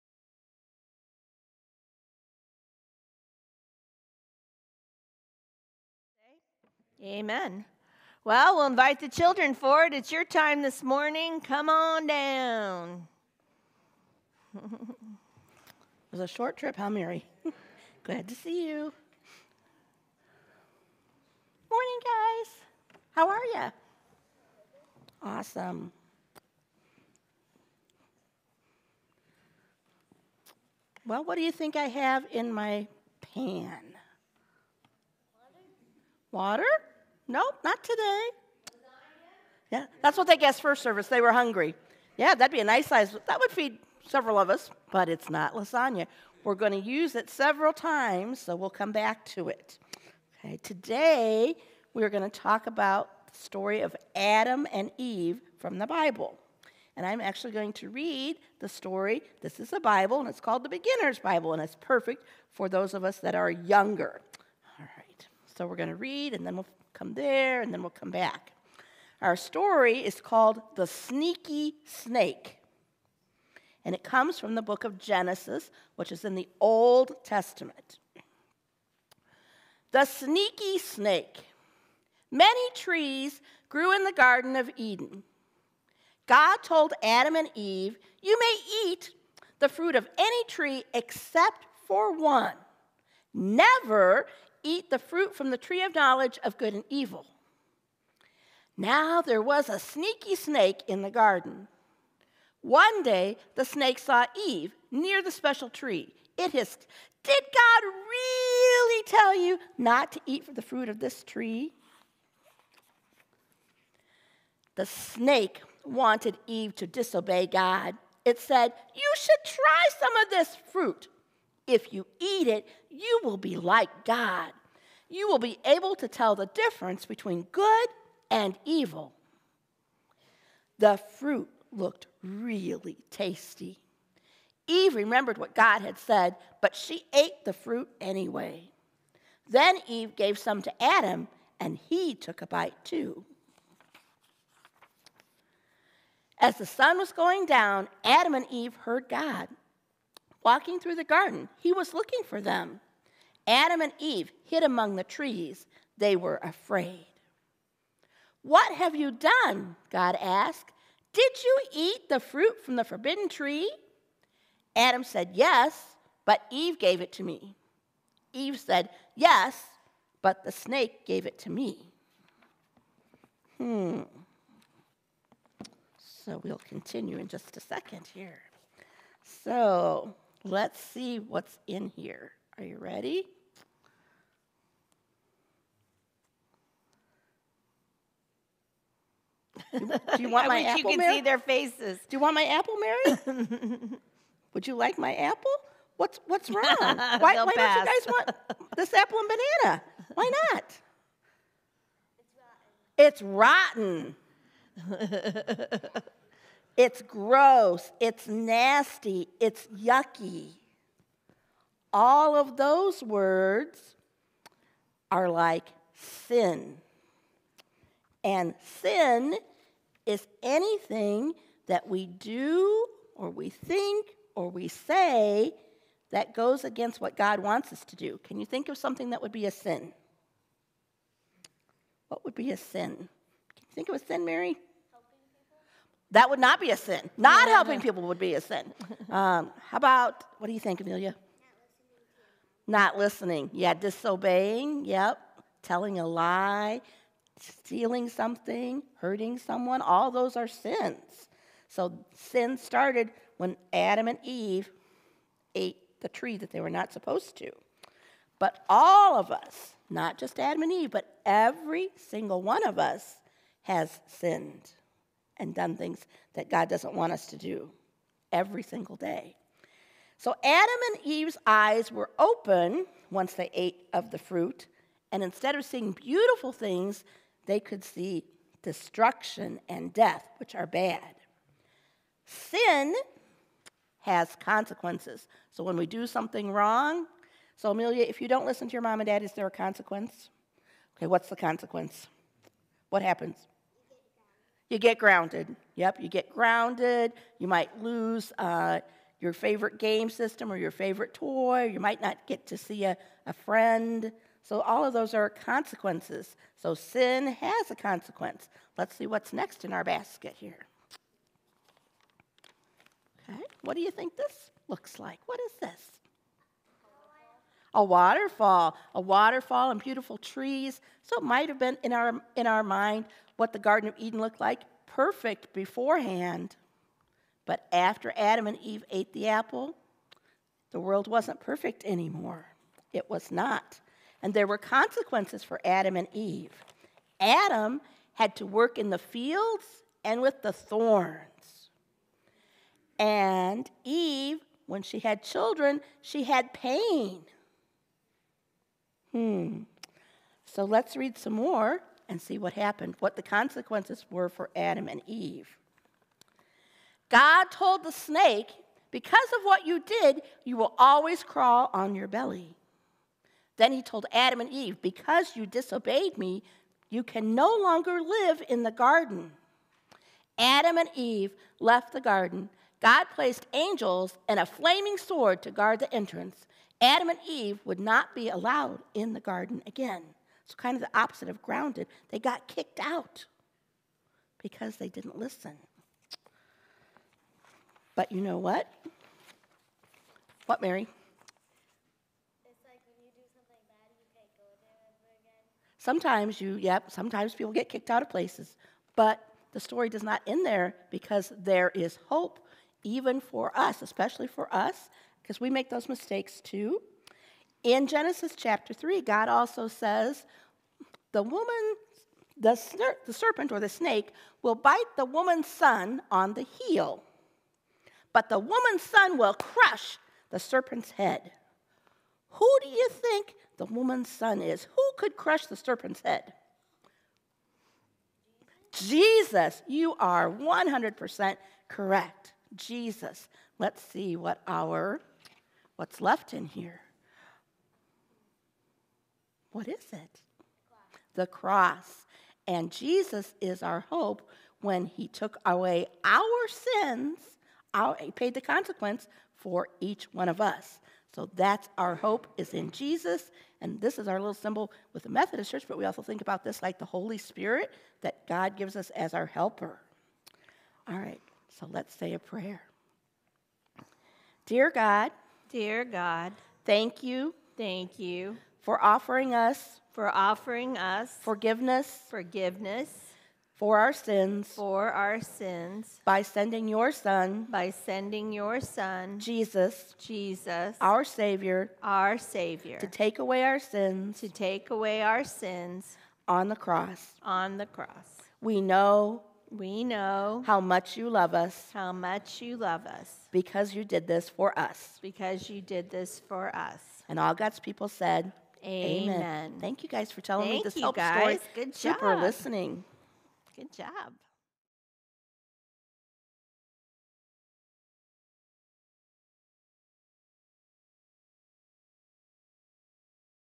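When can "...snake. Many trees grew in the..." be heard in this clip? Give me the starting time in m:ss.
1:20.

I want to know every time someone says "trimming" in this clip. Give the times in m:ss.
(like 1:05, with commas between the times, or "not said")
not said.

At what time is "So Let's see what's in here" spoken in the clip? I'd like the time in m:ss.
2:59.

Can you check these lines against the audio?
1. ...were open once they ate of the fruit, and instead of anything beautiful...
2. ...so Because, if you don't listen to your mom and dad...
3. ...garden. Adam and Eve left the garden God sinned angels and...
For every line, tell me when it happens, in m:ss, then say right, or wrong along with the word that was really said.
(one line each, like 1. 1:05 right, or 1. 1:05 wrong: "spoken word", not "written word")
1. 4:31 wrong: "seeing", not "anything"
2. 4:47 wrong: "Amelia", not "Because"
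3. 6:08 wrong: "placed", not "sinned".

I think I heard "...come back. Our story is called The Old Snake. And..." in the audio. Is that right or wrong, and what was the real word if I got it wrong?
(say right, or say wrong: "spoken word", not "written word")
wrong: "Sneaky", not "Old".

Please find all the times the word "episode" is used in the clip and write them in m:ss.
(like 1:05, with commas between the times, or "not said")
not said.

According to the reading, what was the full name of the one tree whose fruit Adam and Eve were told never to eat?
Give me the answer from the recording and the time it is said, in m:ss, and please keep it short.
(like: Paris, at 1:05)
tree of knowledge of good and evil, at 1:35.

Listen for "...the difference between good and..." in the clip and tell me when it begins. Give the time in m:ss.
2:06.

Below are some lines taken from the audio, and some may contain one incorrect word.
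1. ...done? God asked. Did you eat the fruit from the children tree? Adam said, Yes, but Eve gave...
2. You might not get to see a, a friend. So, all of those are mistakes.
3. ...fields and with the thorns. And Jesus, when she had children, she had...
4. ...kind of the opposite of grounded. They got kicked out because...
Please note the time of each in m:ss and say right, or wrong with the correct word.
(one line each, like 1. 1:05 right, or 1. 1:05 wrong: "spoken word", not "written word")
1. 2:39 wrong: "forbidden", not "children"
2. 5:01 wrong: "consequences", not "mistakes"
3. 5:38 wrong: "Eve", not "Jesus"
4. 6:20 right.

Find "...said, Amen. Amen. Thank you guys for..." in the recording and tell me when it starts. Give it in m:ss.
8:17.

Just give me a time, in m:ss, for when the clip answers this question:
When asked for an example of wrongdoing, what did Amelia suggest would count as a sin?
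4:02.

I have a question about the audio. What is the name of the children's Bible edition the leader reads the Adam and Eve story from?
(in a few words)
Beginner's Bible.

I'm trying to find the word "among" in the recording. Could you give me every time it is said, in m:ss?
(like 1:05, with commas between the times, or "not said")
2:34.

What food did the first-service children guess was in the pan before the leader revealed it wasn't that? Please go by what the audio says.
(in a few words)
Lasagna.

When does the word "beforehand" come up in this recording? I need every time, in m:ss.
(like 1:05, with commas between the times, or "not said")
5:25.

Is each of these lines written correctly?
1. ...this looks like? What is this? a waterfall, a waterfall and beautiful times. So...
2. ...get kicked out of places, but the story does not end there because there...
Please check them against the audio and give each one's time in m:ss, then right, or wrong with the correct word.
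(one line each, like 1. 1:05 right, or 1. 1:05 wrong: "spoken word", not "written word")
1. 5:14 wrong: "trees", not "times"
2. 6:37 right.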